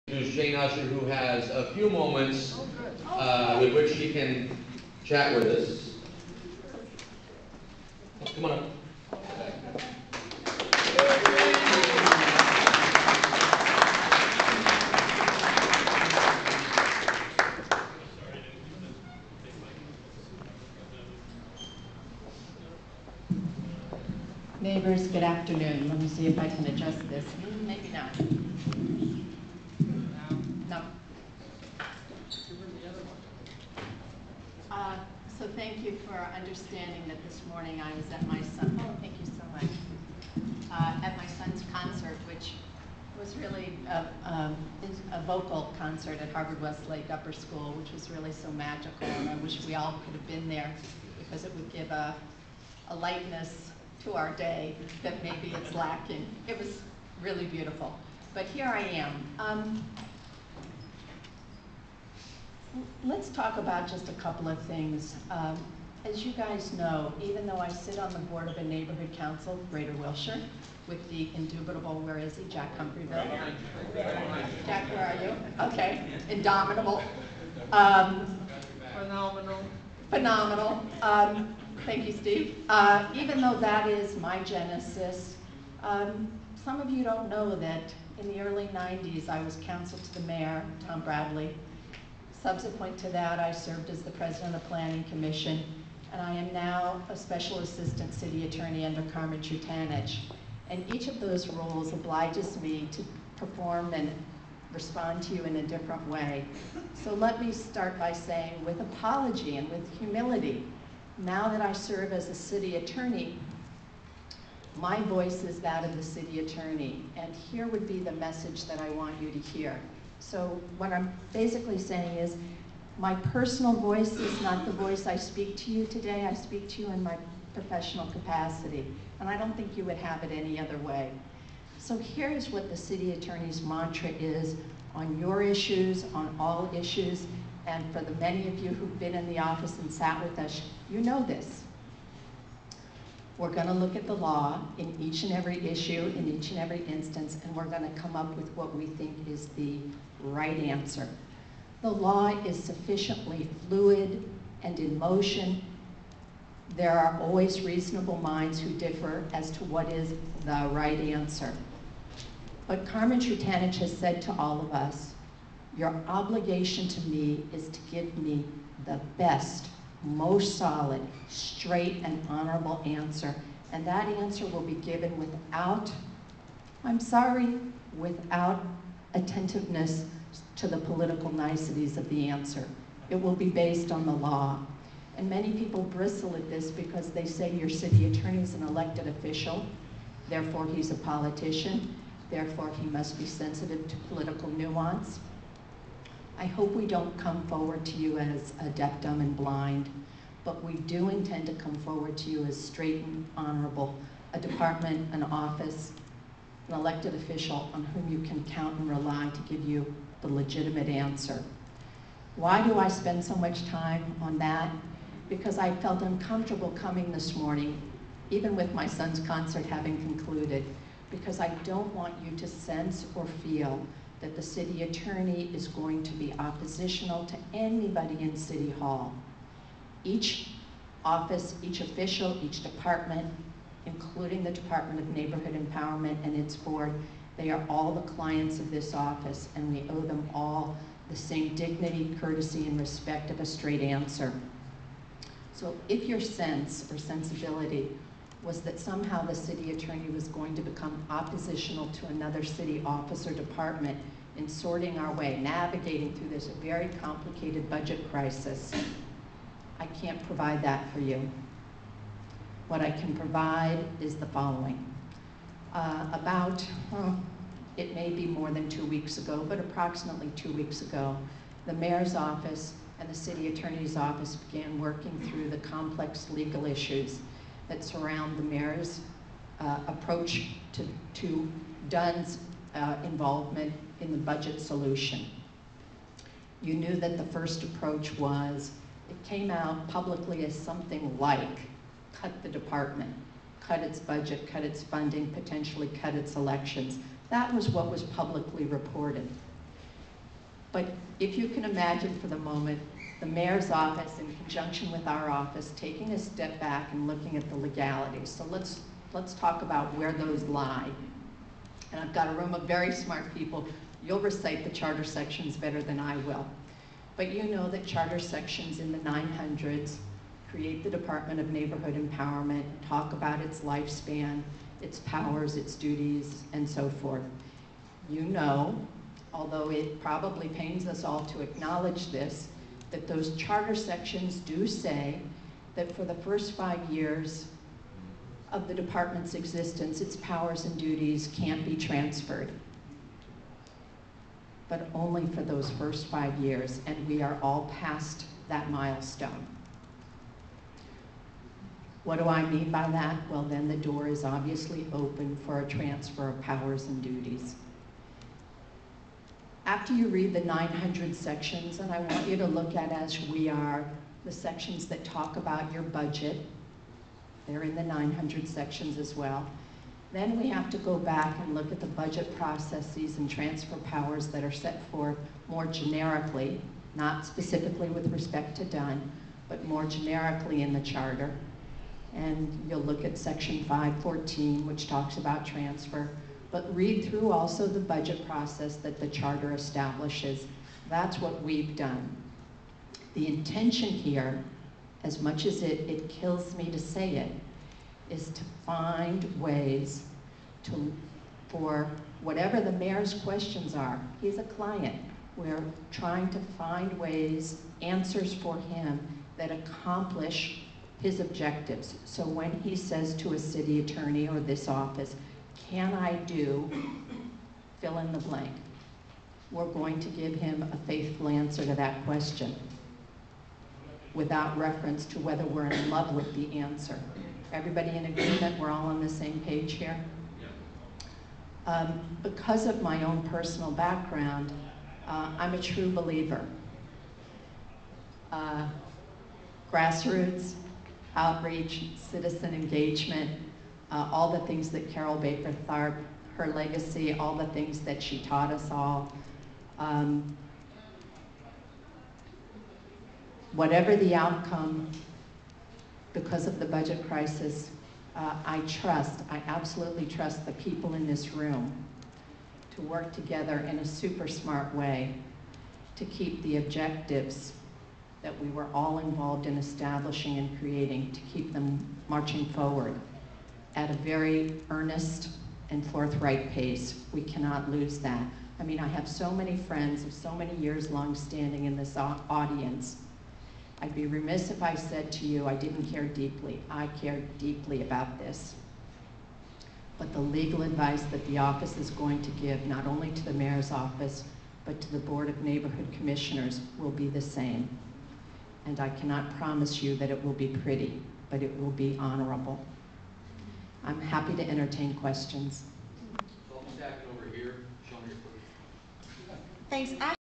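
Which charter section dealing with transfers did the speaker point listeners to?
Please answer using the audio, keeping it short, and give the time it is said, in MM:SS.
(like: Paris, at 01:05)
Section 514, at 06:23.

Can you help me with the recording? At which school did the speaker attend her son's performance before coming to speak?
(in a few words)
Harvard Westlake Upper School.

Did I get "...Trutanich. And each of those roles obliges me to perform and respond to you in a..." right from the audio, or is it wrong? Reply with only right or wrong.
right.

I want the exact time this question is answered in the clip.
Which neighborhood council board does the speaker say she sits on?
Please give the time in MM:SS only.
01:09.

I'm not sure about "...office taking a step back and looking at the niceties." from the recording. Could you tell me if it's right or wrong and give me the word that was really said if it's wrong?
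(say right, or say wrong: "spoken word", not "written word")
wrong: "legalities", not "niceties".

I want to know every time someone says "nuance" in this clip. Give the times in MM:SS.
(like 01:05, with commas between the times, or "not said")
03:14.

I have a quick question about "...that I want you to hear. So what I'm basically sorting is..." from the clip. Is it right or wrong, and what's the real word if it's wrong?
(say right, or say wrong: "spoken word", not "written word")
wrong: "saying", not "sorting".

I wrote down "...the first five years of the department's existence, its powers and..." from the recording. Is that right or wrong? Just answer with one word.
right.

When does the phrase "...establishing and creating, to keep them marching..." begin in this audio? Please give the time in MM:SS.
07:49.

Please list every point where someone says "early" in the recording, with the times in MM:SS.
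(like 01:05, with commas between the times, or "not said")
01:28.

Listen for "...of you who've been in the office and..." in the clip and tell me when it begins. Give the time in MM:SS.
02:18.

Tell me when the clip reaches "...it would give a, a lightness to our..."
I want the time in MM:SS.
00:51.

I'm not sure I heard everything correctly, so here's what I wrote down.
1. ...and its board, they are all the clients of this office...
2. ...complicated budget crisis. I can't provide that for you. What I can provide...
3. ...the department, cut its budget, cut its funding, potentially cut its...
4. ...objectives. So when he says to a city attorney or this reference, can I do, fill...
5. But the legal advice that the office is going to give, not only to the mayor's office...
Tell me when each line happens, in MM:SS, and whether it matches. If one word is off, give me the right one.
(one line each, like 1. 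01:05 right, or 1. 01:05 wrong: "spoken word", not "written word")
1. 03:56 right
2. 04:17 right
3. 04:52 right
4. 06:51 wrong: "office", not "reference"
5. 08:09 right.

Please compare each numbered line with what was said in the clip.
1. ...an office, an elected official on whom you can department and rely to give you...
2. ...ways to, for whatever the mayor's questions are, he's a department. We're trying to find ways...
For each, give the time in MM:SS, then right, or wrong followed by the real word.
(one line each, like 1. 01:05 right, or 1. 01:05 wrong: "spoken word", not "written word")
1. 03:25 wrong: "count", not "department"
2. 06:39 wrong: "client", not "department".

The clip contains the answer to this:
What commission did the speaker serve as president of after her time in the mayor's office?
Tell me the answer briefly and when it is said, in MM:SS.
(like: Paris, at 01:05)
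Planning Commission, at 01:34.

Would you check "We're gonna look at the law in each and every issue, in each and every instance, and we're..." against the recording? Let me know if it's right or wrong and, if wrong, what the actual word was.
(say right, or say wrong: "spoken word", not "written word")
right.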